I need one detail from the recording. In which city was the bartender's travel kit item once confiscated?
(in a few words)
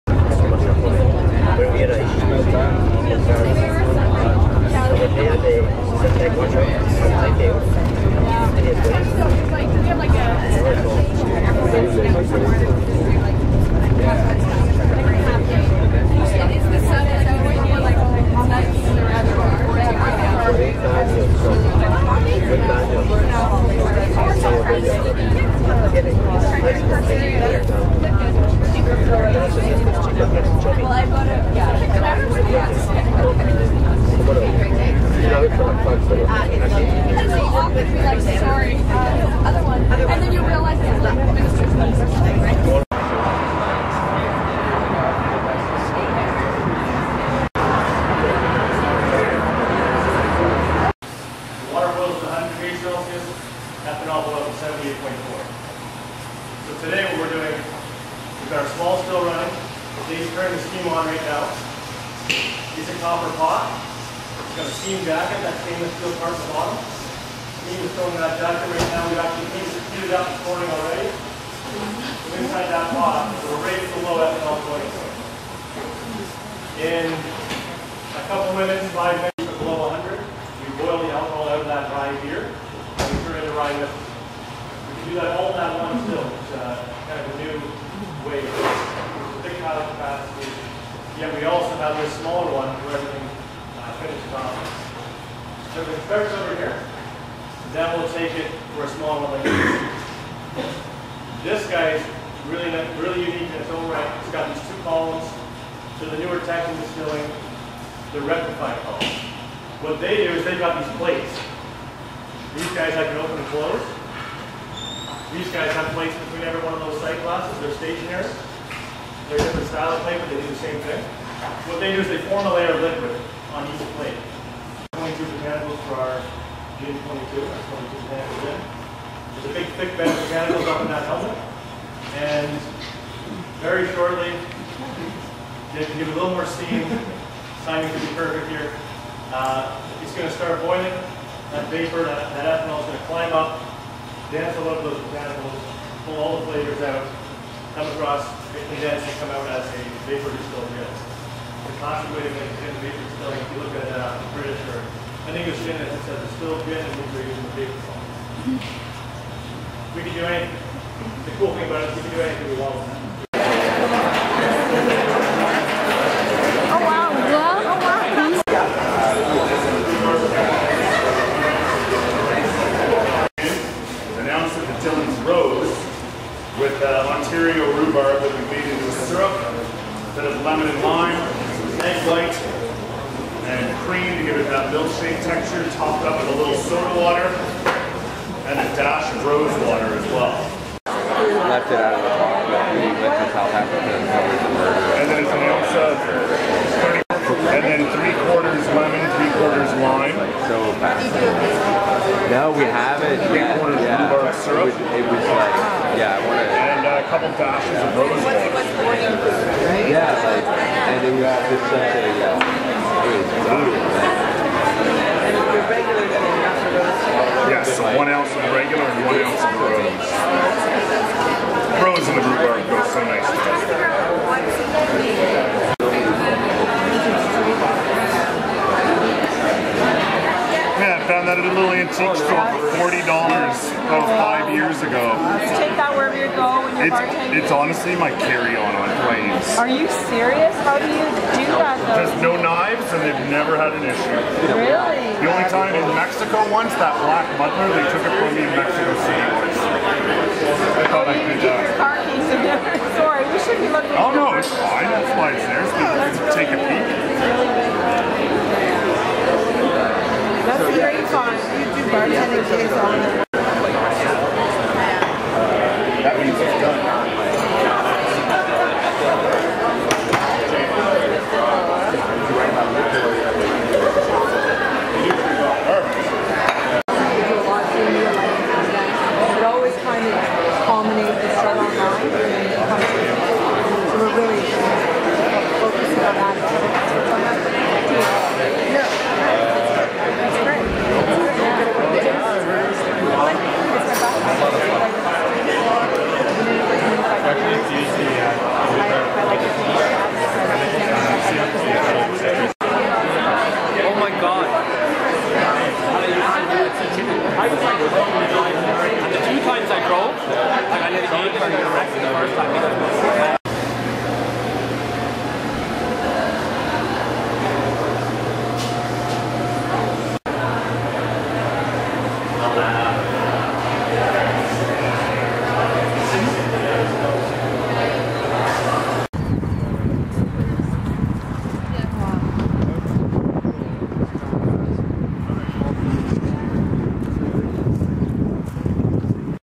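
Mexico City.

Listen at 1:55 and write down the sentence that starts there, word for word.
These guys have plates between every one of those sight glasses.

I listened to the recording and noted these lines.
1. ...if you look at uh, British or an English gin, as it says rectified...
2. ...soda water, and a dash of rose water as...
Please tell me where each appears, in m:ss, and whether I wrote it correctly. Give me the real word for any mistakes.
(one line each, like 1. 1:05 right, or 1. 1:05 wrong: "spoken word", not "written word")
1. 2:33 wrong: "distilled", not "rectified"
2. 3:06 right.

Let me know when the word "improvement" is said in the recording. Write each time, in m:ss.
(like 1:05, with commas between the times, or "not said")
not said.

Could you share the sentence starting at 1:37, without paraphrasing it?
Then we'll take it for a smaller one like this.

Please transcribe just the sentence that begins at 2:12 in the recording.
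And very shortly, to give it a little more steam, timing could be perfect here.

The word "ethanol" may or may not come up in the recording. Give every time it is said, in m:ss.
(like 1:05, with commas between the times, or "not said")
0:53, 1:14, 2:22.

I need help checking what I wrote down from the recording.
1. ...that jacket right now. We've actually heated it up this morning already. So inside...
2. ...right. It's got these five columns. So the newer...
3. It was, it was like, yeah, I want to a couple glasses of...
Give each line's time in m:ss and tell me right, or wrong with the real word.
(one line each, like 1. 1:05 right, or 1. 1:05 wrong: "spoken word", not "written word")
1. 1:08 right
2. 1:43 wrong: "two", not "five"
3. 3:24 wrong: "dashes", not "glasses".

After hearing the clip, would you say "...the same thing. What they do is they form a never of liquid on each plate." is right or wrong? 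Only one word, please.
wrong.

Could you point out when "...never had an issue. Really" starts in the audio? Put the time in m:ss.
4:03.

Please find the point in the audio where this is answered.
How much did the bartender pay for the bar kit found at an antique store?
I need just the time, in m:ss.
3:52.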